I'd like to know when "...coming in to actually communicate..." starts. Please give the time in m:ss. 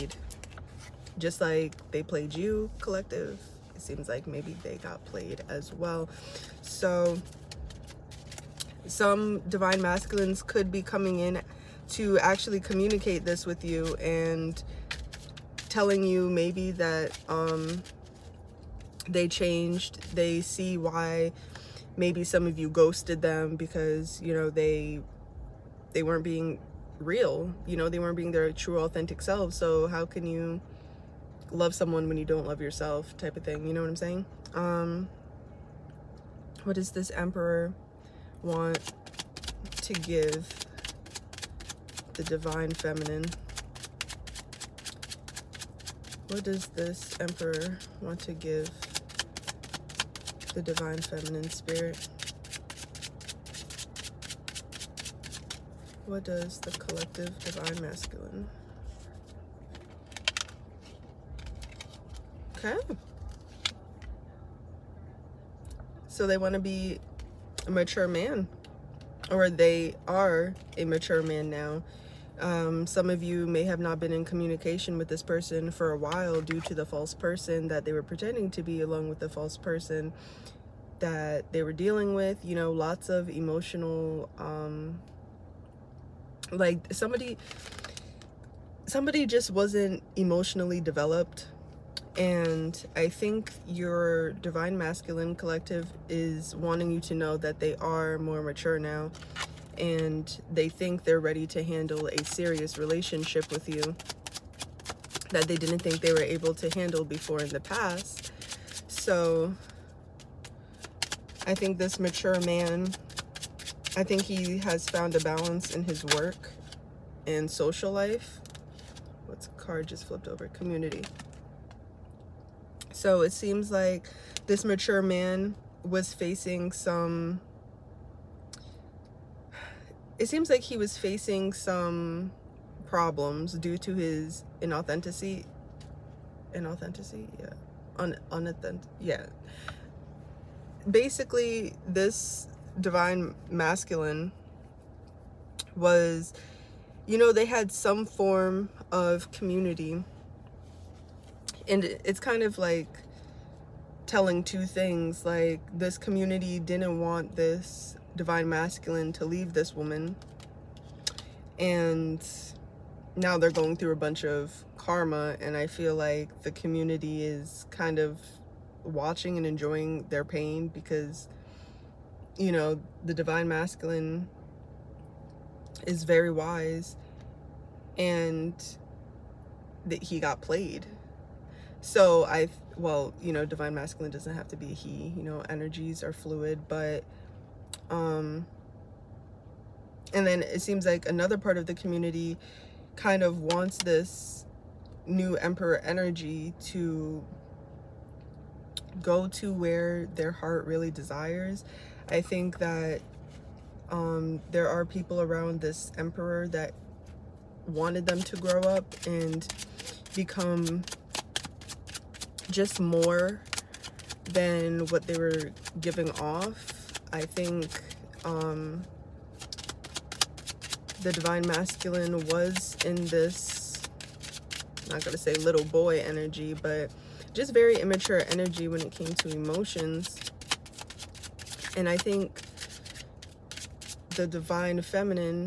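0:10.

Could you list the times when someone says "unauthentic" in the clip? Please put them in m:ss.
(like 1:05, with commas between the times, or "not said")
2:18.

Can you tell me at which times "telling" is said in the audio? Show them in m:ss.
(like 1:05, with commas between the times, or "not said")
0:15, 2:34.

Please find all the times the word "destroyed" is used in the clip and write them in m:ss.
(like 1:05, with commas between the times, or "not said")
not said.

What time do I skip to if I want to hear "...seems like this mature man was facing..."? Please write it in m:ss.
2:03.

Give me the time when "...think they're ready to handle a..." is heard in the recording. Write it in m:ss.
1:40.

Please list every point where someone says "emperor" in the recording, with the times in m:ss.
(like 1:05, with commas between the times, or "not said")
0:37, 0:47, 3:15, 3:25.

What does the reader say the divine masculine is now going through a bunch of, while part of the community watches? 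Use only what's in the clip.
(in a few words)
Karma.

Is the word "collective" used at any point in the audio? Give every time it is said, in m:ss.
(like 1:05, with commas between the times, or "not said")
0:02, 0:56, 1:35.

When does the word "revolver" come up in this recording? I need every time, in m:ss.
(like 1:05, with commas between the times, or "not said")
not said.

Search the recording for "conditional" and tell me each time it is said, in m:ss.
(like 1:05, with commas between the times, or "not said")
not said.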